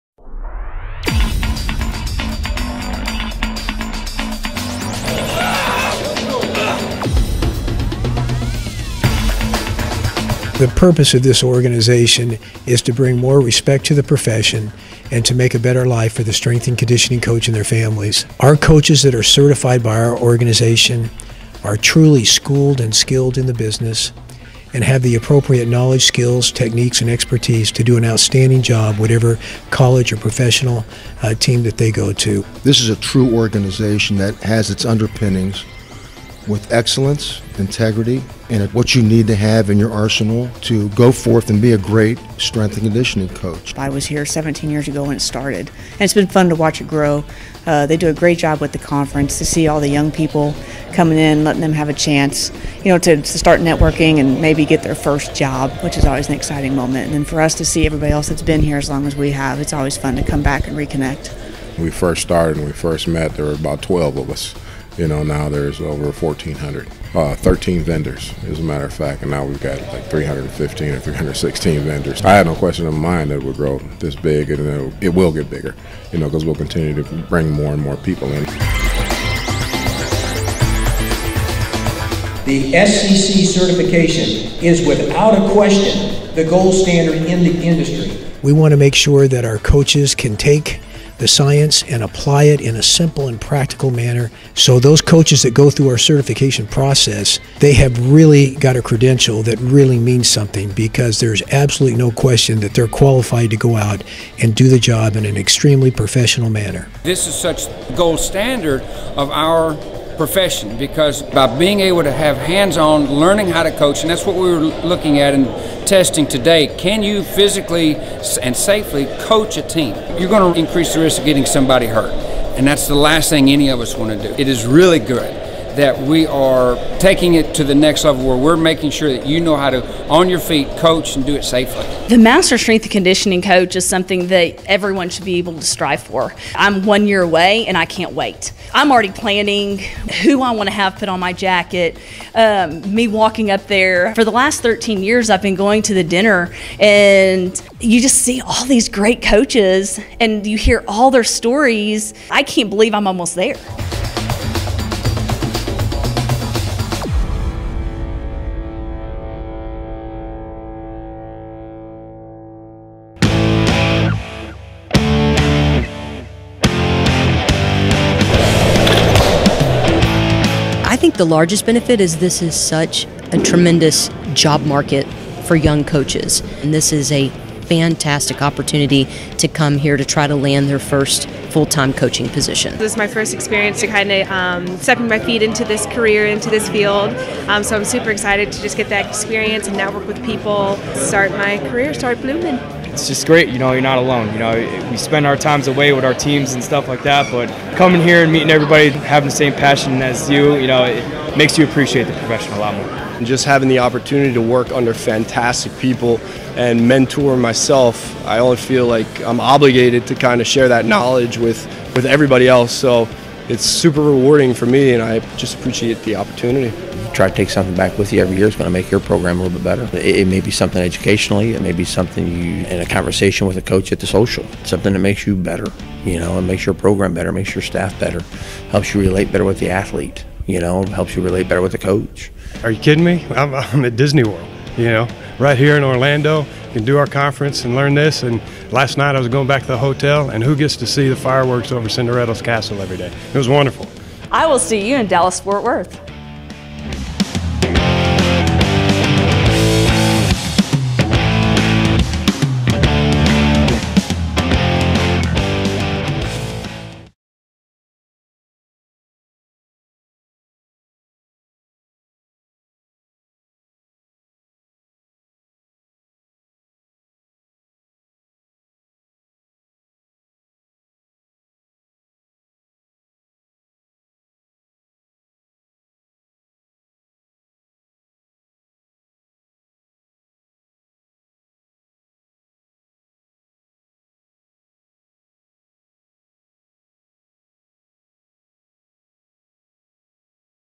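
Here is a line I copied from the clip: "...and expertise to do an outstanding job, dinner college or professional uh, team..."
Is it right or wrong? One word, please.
wrong.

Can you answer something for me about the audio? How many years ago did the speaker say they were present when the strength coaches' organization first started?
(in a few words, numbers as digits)
17.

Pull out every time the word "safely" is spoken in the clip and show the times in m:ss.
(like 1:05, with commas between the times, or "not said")
1:58, 2:11.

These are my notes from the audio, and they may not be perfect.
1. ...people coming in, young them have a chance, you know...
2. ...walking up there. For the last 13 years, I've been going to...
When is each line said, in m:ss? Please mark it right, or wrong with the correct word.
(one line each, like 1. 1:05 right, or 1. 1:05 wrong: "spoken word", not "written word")
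1. 0:50 wrong: "letting", not "young"
2. 2:23 right.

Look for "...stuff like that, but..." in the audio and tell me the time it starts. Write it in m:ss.
3:16.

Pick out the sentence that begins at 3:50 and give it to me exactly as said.
You know, helps you relate better with the coach.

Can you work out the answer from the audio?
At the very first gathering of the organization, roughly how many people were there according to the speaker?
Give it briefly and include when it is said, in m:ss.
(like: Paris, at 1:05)
12, at 1:03.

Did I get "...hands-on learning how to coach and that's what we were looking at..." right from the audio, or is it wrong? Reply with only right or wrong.
right.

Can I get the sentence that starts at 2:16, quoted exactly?
I'm one year away and I can't wait.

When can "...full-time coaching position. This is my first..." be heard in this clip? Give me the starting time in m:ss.
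3:01.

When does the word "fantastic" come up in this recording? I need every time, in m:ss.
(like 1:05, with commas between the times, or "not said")
2:57, 3:24.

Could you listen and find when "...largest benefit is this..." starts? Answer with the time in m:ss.
2:51.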